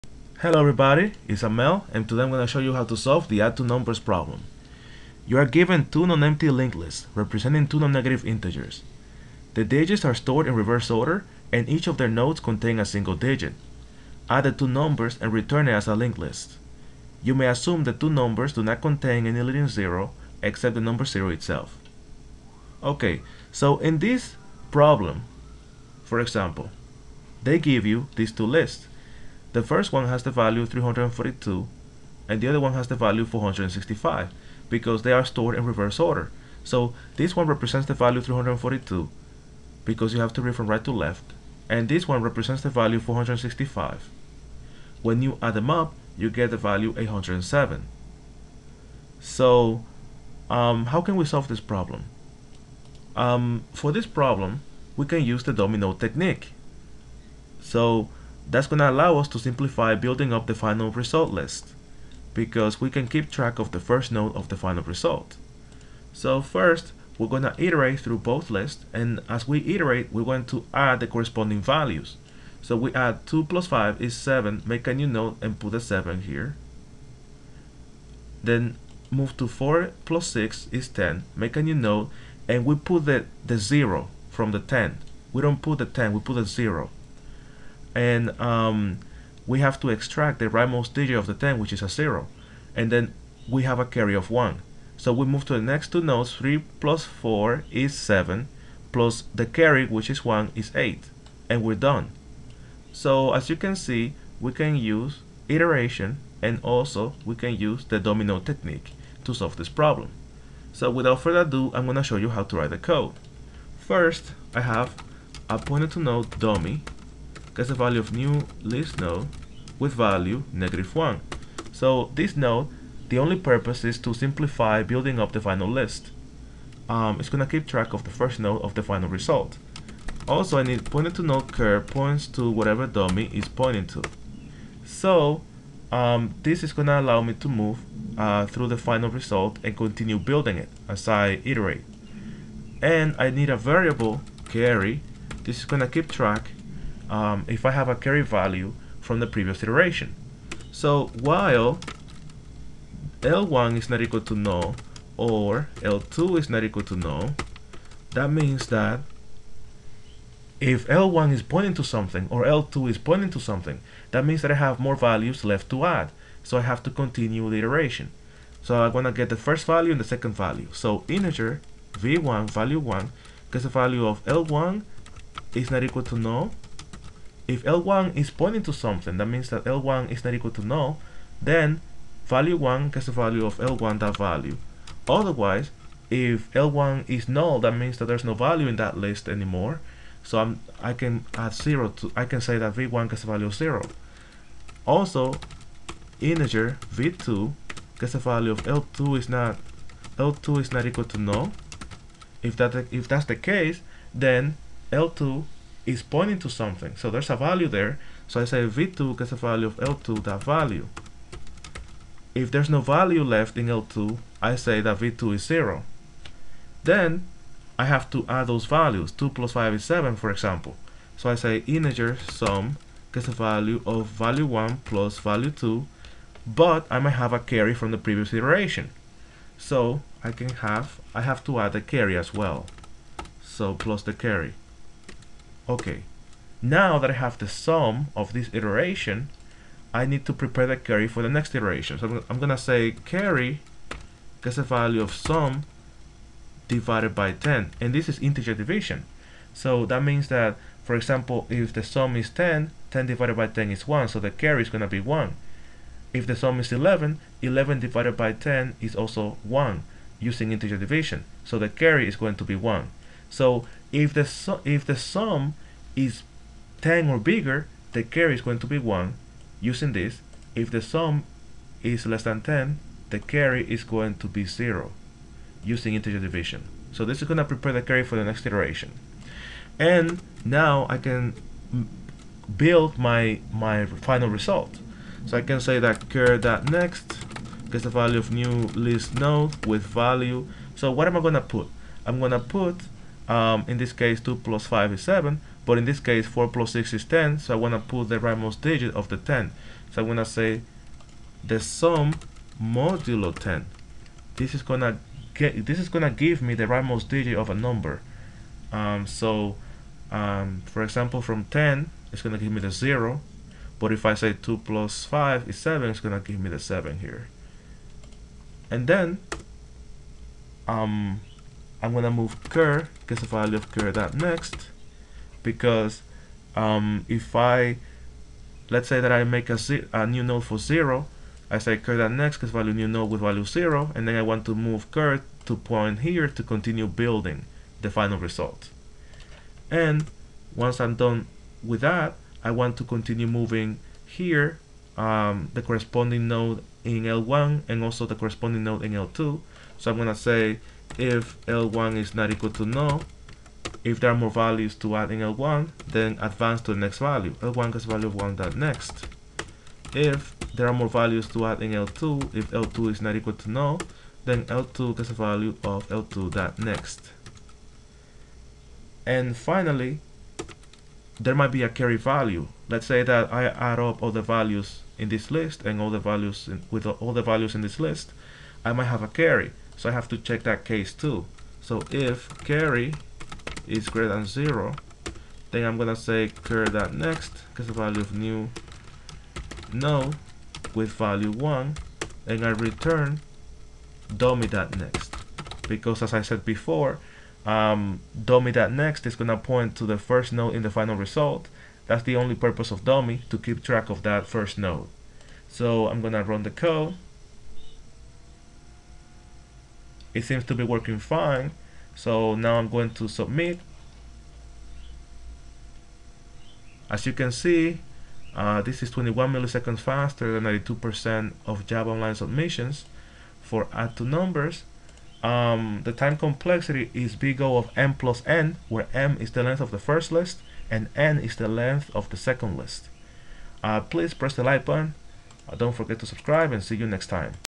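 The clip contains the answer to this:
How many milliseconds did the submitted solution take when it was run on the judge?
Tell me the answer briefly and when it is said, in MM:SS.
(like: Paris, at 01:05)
21, at 06:58.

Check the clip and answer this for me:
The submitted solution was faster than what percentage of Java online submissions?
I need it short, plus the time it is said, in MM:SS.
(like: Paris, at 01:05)
92%, at 07:00.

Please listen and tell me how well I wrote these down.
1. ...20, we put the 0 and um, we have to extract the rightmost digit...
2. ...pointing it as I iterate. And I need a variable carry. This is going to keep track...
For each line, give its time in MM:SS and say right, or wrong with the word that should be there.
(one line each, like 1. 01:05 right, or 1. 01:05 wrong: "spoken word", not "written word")
1. 01:25 wrong: "10", not "20"
2. 02:20 wrong: "building", not "pointing".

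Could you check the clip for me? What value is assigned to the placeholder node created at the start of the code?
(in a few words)
-1.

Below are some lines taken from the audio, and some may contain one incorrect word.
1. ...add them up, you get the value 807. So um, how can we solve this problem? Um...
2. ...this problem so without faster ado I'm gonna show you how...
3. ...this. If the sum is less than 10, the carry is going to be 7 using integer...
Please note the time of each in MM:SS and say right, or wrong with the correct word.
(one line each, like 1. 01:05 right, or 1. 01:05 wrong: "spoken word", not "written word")
1. 00:45 right
2. 01:49 wrong: "further", not "faster"
3. 04:29 wrong: "0", not "7".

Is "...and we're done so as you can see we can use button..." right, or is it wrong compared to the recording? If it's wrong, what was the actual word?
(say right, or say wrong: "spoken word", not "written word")
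wrong: "iteration", not "button".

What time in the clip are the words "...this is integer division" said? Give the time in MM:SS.
04:07.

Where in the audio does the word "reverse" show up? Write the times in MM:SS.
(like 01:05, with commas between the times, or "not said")
00:10, 00:35.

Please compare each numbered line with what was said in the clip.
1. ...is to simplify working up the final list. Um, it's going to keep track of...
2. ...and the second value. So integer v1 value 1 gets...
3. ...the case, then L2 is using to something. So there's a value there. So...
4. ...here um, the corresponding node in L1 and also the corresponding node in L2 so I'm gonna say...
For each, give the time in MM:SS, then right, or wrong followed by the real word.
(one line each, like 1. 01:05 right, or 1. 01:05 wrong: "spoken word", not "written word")
1. 02:03 wrong: "building", not "working"
2. 02:49 right
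3. 03:23 wrong: "pointing", not "using"
4. 05:44 right.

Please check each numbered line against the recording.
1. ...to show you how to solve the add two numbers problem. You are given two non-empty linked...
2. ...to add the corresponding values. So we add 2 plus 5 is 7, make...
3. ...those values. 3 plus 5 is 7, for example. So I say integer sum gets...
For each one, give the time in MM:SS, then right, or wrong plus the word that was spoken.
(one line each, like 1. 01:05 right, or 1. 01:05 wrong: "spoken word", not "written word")
1. 00:02 right
2. 01:10 right
3. 03:38 wrong: "2", not "3".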